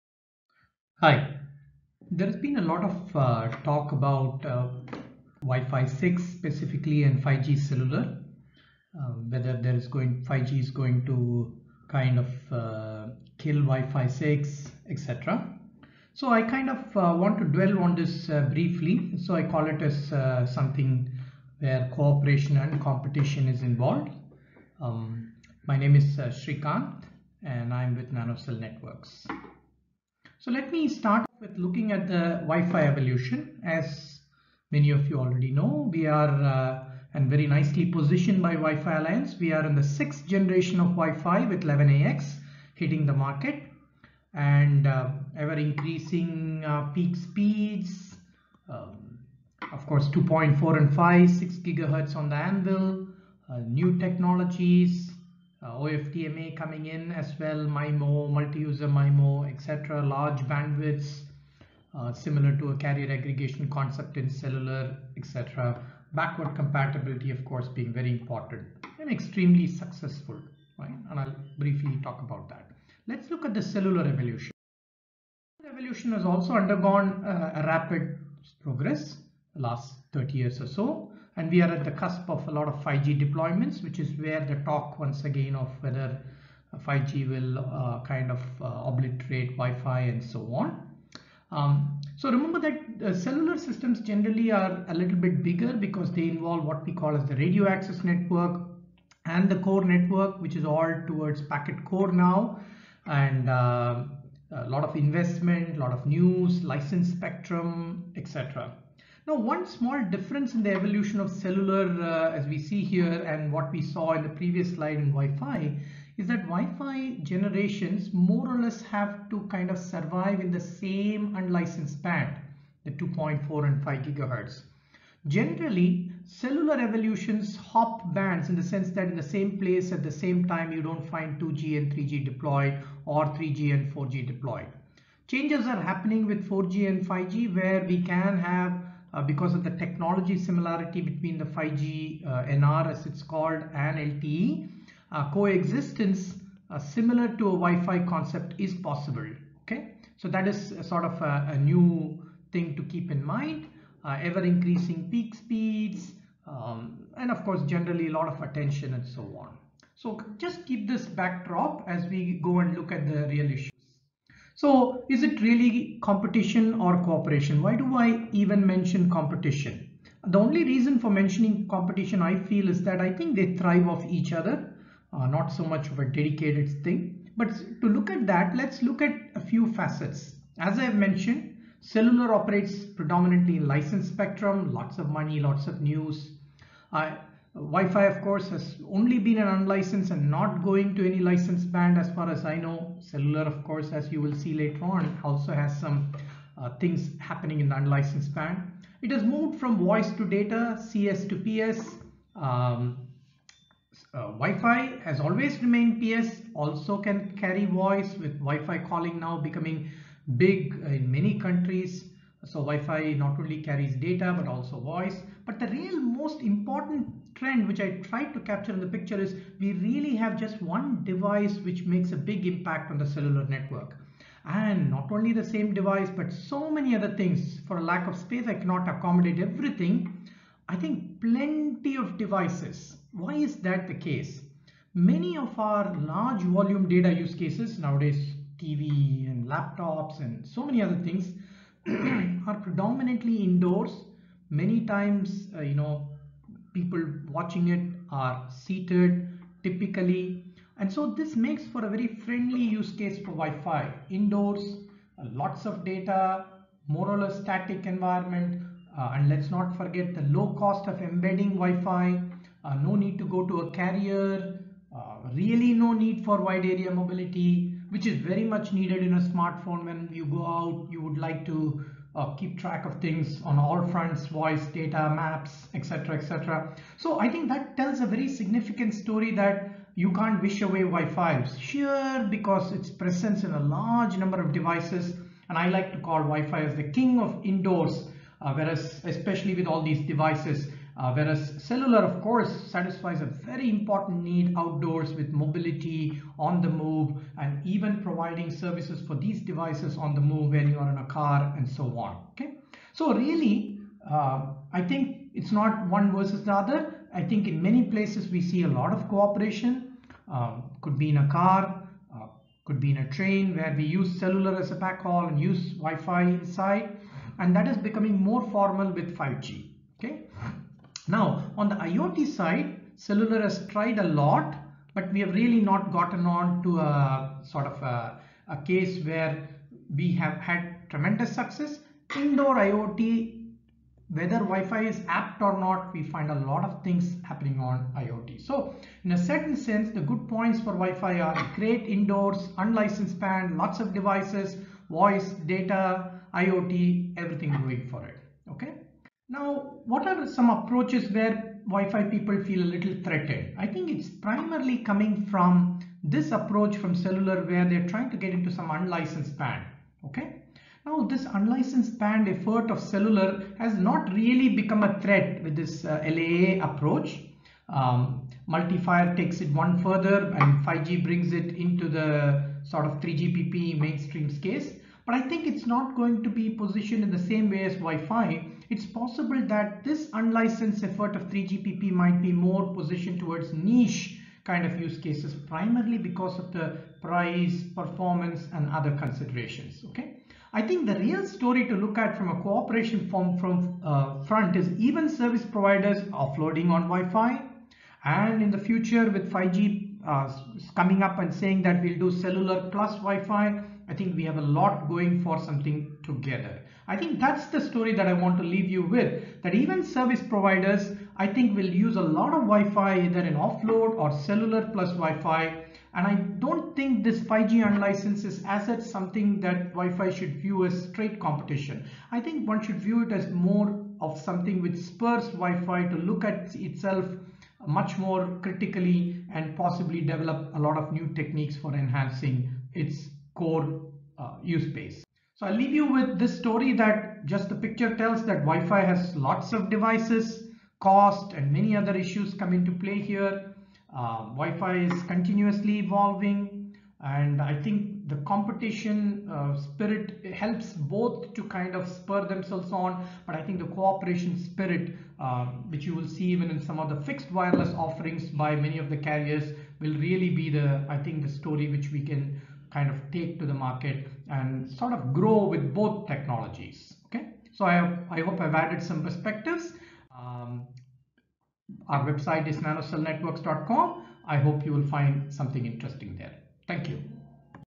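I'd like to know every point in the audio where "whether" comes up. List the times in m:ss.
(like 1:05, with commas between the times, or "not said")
0:09, 1:25, 5:34.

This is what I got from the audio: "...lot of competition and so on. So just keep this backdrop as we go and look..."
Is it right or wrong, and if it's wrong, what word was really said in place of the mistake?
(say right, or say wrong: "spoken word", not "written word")
wrong: "attention", not "competition".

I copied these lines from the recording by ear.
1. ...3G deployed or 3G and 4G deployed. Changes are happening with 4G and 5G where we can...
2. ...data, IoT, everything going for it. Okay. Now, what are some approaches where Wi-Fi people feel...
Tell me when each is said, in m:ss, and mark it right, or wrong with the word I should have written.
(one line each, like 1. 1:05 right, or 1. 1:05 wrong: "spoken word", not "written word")
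1. 2:11 right
2. 5:45 right.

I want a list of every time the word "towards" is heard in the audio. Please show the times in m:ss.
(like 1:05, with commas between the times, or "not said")
1:41, 6:23.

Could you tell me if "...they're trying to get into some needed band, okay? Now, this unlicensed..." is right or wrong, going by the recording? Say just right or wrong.
wrong.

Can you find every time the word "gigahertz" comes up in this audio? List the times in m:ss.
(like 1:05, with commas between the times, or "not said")
0:51, 2:04.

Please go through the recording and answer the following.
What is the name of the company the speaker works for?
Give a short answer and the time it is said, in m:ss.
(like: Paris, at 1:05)
NanoCell Networks, at 0:28.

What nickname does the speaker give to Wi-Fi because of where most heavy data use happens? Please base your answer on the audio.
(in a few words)
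king of indoors.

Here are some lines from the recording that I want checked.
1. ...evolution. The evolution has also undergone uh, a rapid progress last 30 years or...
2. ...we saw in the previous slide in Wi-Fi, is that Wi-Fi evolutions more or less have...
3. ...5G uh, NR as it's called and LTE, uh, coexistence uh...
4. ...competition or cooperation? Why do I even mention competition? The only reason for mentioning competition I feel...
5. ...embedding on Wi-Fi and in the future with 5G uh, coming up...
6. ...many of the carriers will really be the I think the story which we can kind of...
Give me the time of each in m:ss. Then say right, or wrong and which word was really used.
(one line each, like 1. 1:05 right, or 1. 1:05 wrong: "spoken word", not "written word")
1. 1:14 right
2. 1:53 wrong: "generations", not "evolutions"
3. 2:21 right
4. 2:46 right
5. 6:36 wrong: "offloading", not "embedding"
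6. 7:38 right.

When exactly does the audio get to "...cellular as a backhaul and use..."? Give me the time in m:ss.
5:14.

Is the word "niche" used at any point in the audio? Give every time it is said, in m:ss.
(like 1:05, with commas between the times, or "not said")
6:23.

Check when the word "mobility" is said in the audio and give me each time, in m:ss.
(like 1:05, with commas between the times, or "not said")
4:26, 4:55.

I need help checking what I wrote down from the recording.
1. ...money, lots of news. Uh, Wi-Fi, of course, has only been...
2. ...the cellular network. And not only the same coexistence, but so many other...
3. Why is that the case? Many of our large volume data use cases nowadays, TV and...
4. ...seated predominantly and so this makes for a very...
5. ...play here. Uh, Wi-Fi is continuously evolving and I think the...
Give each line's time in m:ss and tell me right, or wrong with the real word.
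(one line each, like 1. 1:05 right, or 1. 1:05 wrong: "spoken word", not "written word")
1. 3:05 right
2. 3:42 wrong: "device", not "coexistence"
3. 3:53 right
4. 4:08 wrong: "typically", not "predominantly"
5. 7:22 right.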